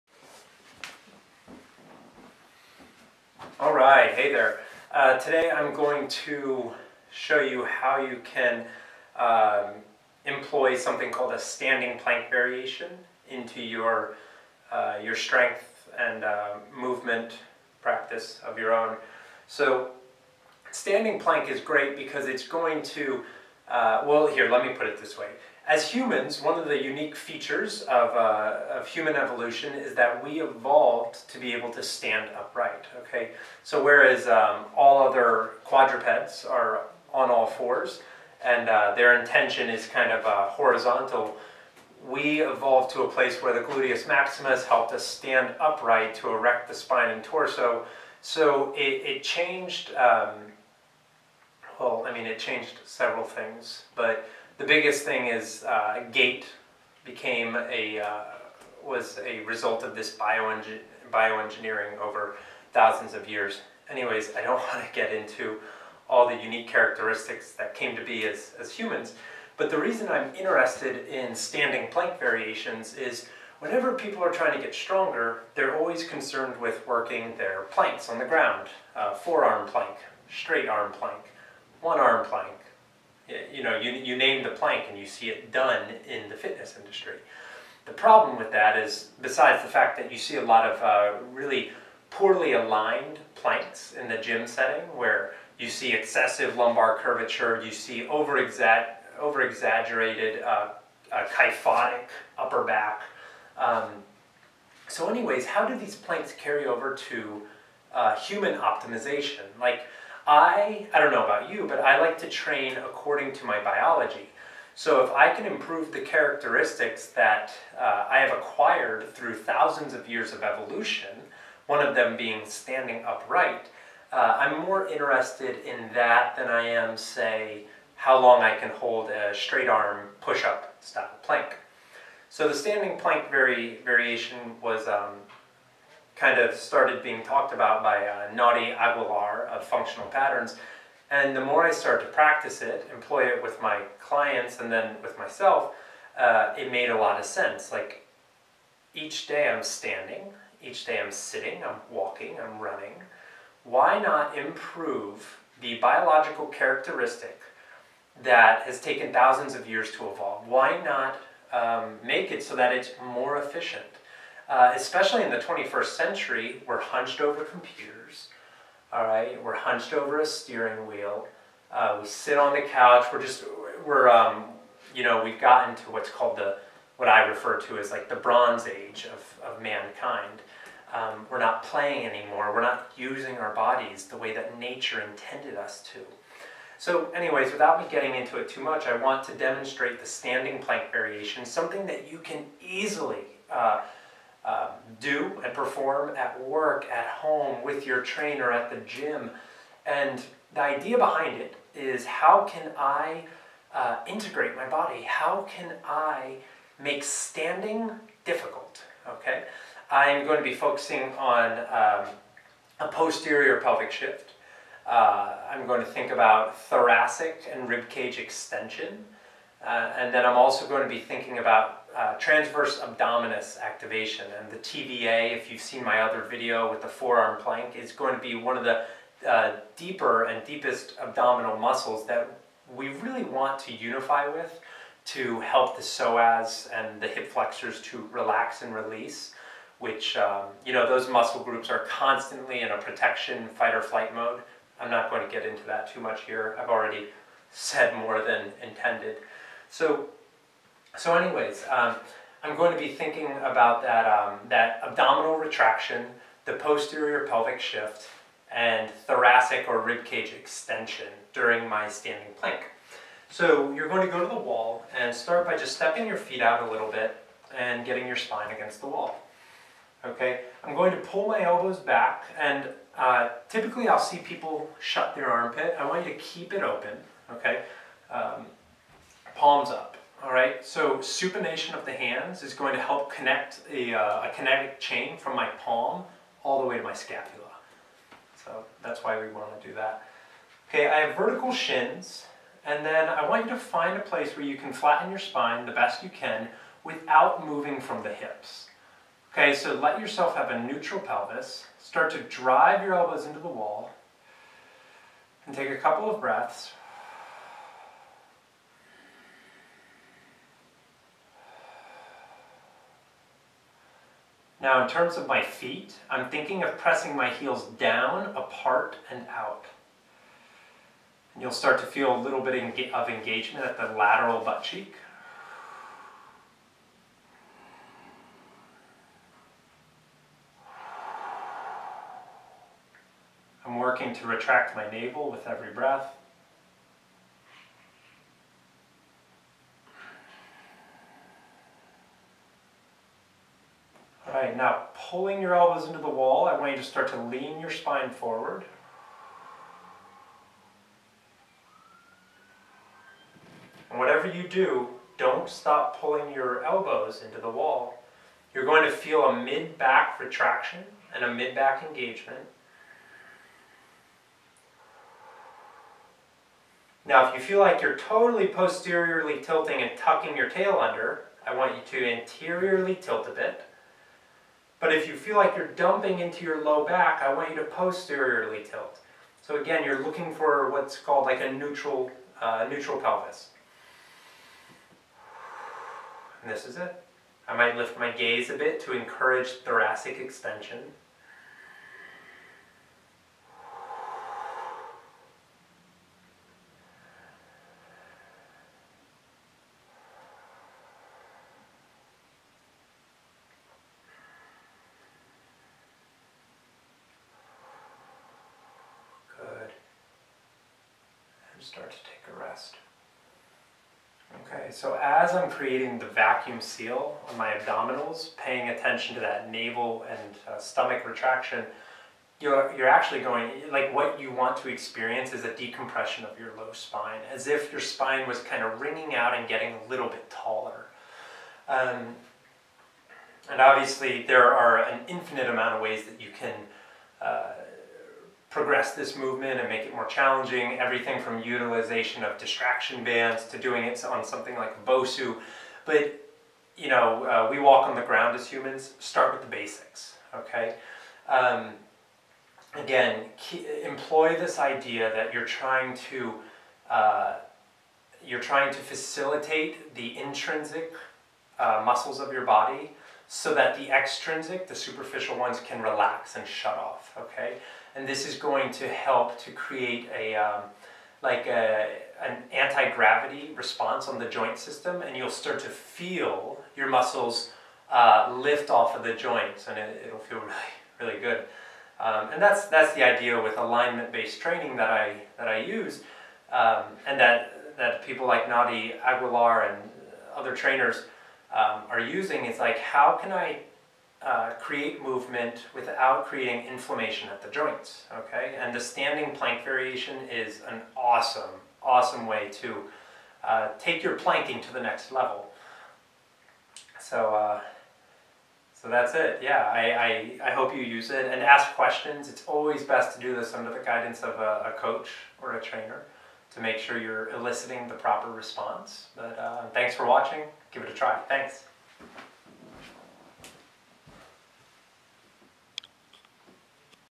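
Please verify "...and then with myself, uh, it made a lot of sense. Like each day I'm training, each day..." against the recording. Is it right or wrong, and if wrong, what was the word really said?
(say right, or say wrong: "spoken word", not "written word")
wrong: "standing", not "training".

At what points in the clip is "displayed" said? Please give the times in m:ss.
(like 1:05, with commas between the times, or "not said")
not said.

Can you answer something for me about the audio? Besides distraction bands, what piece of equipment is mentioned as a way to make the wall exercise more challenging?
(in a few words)
BOSU.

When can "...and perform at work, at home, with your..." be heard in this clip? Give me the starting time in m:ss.
3:15.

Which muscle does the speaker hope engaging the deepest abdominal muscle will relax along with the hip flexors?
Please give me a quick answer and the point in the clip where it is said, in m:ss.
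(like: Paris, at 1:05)
psoas, at 3:55.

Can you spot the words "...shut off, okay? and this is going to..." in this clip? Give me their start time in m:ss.
7:46.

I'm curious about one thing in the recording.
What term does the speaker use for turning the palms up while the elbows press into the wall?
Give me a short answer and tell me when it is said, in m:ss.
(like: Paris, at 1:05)
supination, at 4:40.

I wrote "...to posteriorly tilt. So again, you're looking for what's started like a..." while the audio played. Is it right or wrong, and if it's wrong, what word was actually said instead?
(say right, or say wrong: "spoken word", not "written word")
wrong: "called", not "started".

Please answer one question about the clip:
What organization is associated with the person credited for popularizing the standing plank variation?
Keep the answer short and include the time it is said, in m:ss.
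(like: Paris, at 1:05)
Functional Patterns, at 2:19.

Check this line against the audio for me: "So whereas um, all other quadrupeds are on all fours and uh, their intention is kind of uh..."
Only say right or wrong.
right.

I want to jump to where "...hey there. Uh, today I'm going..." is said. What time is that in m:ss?
0:04.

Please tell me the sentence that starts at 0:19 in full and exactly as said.
So standing plank is great because it's going to, uh, well here, let me put it this way.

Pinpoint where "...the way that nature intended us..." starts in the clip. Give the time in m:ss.
3:04.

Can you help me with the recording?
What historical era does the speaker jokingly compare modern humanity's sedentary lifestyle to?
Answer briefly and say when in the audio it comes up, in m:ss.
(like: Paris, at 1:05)
Bronze Age, at 2:58.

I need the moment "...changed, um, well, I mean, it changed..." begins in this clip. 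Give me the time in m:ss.
0:49.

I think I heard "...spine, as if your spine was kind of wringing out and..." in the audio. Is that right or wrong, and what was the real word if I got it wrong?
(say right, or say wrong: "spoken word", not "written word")
right.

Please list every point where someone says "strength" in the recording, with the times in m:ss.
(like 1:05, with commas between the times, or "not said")
0:15.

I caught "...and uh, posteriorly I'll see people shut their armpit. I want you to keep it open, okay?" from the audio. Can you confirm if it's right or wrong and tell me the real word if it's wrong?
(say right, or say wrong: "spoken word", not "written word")
wrong: "typically", not "posteriorly".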